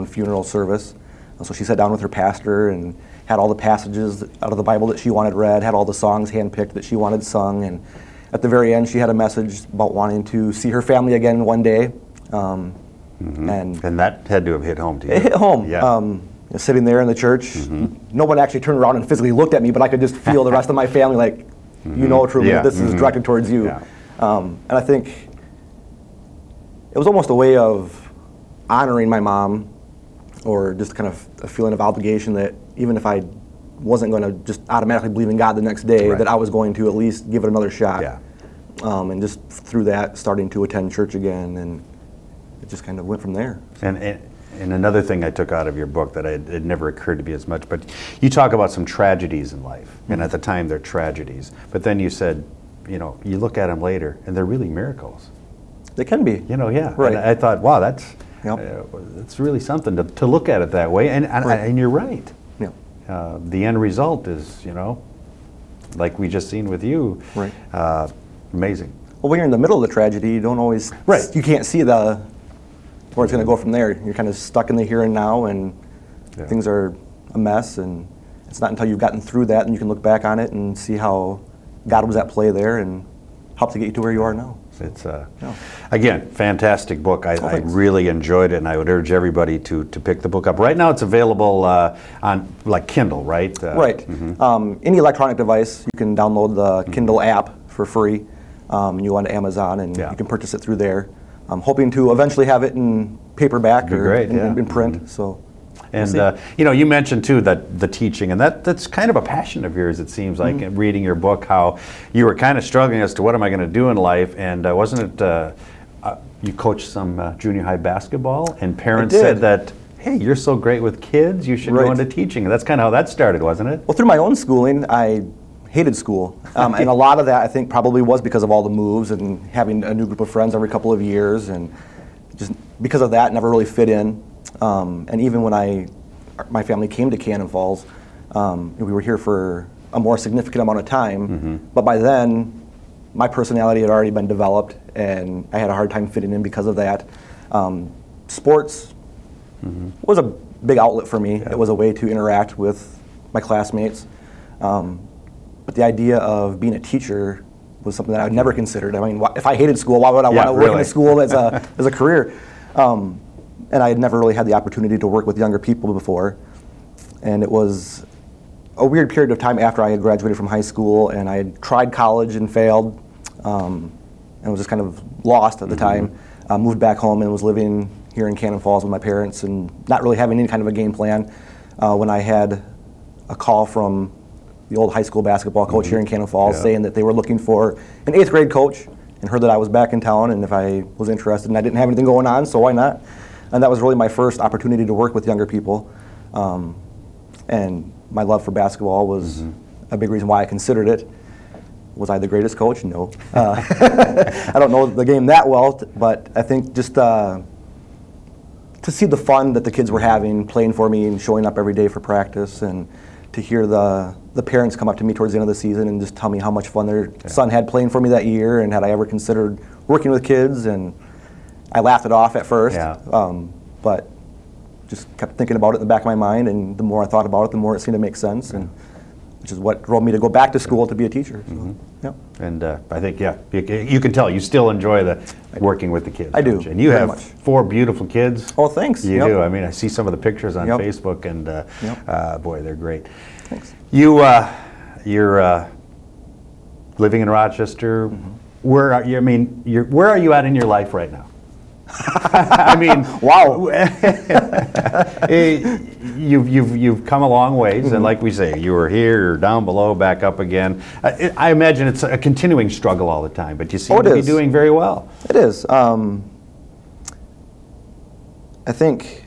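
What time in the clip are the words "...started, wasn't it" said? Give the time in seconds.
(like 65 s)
123 s.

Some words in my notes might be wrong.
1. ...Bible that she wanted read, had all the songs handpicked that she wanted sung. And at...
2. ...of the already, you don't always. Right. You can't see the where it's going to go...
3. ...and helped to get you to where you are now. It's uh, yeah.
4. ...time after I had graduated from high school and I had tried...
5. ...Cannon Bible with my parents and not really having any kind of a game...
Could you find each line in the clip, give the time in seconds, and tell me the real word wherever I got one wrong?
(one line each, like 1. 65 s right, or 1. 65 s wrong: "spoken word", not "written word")
1. 4 s right
2. 69 s wrong: "tragedy", not "already"
3. 82 s right
4. 169 s right
5. 178 s wrong: "Falls", not "Bible".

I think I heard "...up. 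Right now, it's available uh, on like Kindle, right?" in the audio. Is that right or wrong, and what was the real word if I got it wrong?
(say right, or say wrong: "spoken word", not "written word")
right.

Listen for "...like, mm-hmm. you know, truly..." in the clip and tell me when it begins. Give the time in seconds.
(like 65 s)
21 s.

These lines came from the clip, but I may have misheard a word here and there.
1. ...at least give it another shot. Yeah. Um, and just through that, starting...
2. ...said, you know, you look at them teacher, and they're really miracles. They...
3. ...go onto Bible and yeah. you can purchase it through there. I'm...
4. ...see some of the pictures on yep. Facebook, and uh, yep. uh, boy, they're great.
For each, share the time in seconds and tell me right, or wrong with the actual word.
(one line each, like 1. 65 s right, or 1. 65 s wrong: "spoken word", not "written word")
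1. 36 s right
2. 52 s wrong: "later", not "teacher"
3. 99 s wrong: "Amazon", not "Bible"
4. 239 s right.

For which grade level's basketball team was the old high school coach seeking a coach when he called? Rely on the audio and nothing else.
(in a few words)
Eighth grade.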